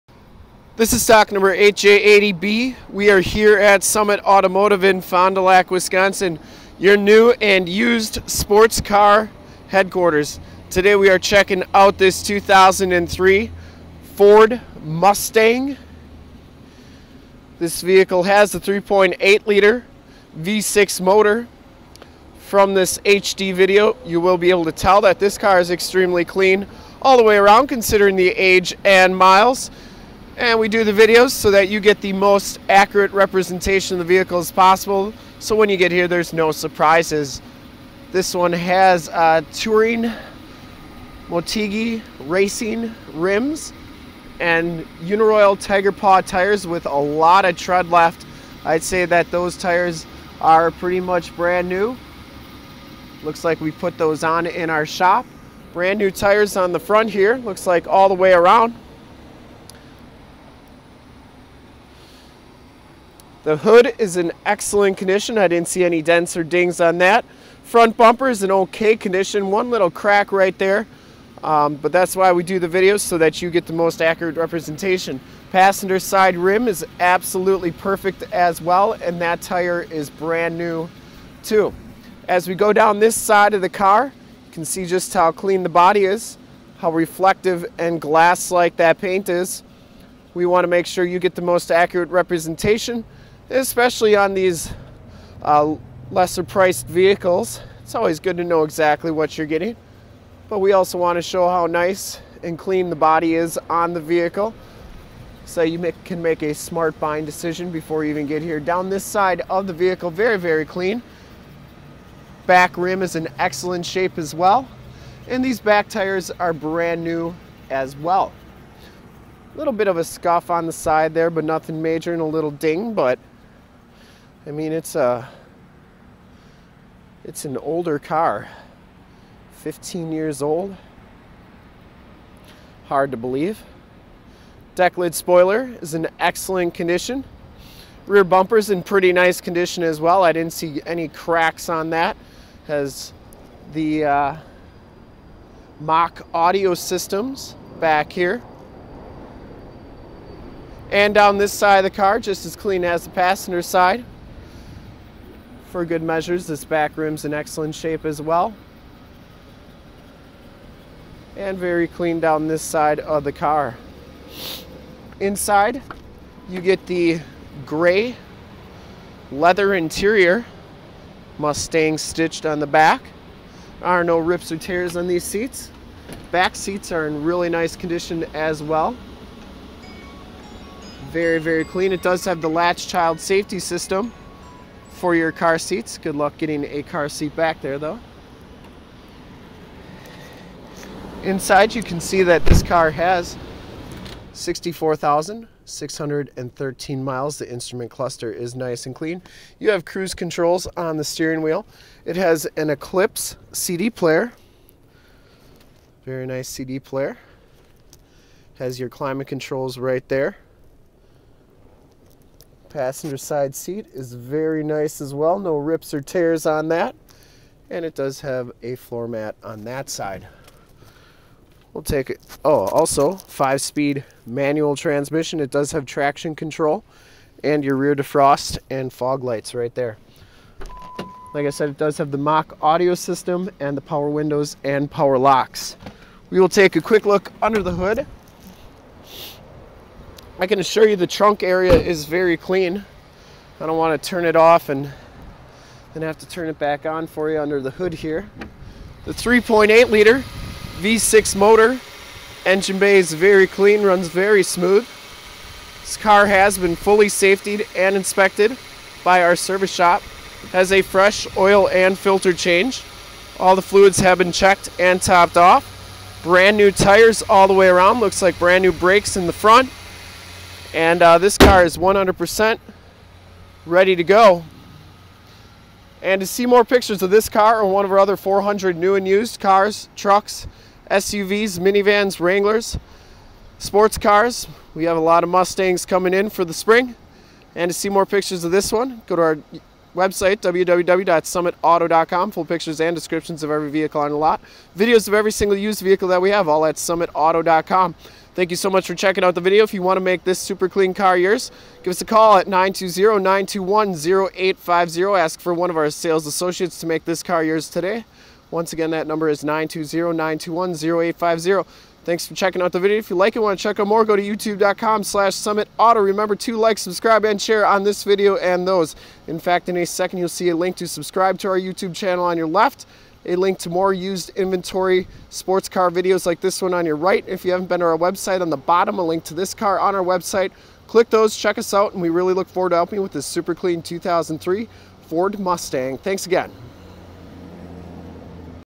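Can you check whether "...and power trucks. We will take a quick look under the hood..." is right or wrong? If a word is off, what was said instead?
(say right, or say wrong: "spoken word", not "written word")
wrong: "locks", not "trucks".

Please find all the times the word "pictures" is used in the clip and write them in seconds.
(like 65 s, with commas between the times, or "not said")
276 s, 288 s, 292 s.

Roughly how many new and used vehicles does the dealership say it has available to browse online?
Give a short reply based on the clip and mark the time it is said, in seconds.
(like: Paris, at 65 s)
400, at 278 s.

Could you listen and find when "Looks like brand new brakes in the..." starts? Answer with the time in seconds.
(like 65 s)
267 s.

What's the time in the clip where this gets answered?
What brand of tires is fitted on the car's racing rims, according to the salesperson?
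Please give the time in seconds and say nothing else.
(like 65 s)
45 s.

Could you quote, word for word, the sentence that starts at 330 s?
Click those, check us out, and we really look forward to helping you with this super clean 2003 Ford Mustang.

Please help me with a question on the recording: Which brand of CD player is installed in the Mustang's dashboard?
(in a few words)
Eclipse.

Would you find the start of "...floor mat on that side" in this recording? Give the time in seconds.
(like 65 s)
218 s.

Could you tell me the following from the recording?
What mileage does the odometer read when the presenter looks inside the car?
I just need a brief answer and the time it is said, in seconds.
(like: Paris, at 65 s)
64,613, at 194 s.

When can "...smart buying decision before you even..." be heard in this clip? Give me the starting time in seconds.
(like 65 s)
106 s.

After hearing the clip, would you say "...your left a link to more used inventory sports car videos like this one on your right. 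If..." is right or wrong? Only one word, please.
right.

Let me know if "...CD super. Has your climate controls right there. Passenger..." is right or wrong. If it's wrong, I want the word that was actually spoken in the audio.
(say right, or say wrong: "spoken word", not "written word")
wrong: "player", not "super".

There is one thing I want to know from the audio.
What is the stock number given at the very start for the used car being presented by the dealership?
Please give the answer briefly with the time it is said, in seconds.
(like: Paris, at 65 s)
8J80B, at 1 s.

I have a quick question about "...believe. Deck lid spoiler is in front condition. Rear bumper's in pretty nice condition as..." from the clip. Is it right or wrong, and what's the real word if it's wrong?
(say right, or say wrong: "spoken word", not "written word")
wrong: "excellent", not "front".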